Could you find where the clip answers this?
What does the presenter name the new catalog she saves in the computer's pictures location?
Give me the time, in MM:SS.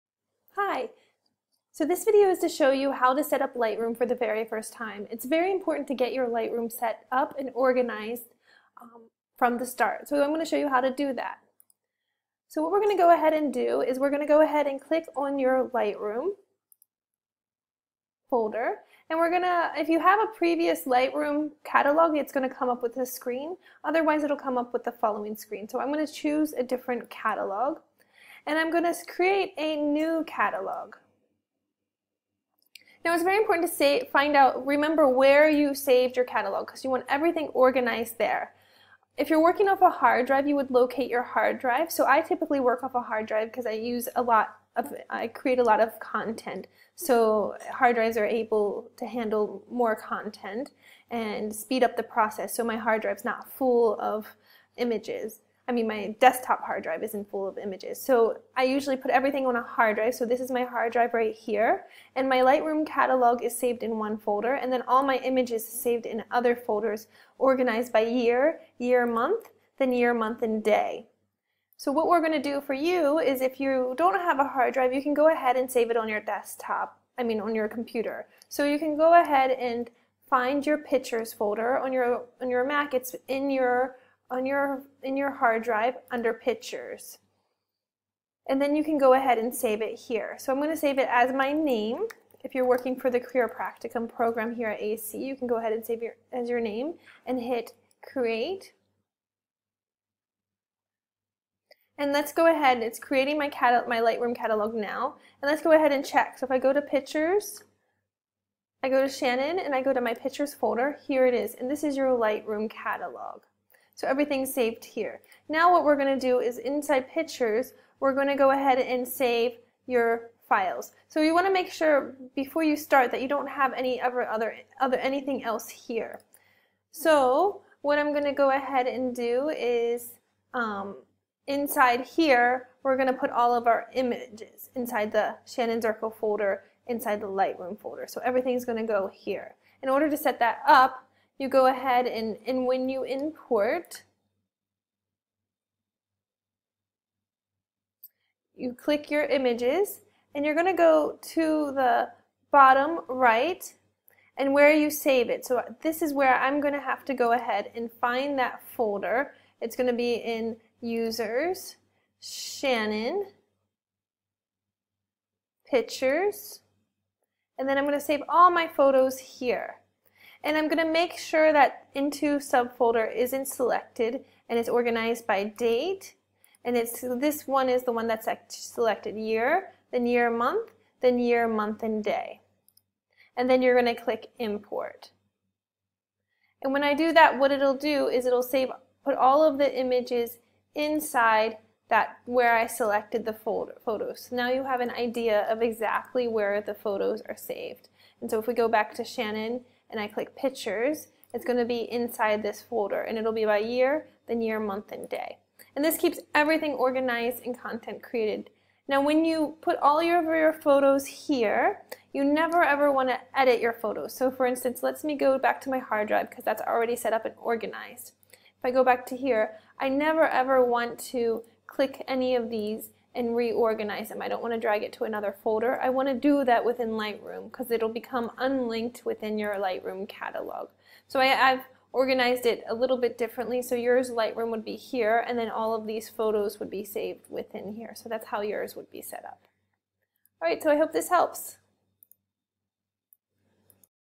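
01:31.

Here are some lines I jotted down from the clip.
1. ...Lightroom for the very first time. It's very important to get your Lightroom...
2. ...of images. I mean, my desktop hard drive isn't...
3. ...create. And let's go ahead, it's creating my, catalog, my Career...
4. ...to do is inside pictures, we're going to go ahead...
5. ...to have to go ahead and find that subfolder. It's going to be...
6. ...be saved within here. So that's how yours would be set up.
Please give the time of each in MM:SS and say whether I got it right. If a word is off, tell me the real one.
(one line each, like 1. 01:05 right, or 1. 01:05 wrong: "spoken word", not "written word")
1. 00:03 right
2. 00:53 right
3. 01:38 wrong: "Lightroom", not "Career"
4. 01:56 right
5. 02:36 wrong: "folder", not "subfolder"
6. 03:56 right.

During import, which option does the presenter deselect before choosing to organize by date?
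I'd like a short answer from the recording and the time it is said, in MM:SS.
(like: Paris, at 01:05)
into subfolder, at 02:51.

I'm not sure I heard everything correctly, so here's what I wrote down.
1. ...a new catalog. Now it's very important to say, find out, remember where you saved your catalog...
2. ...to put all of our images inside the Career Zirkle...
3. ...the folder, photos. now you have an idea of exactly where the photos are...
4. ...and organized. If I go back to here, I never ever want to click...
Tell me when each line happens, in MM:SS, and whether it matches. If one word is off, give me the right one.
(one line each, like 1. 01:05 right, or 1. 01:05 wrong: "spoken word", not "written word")
1. 00:29 right
2. 02:13 wrong: "Shannon", not "Career"
3. 03:13 right
4. 03:37 right.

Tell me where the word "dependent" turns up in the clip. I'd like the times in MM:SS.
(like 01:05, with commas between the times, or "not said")
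not said.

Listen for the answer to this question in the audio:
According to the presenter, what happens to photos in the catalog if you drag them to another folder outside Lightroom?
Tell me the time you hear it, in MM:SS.
03:47.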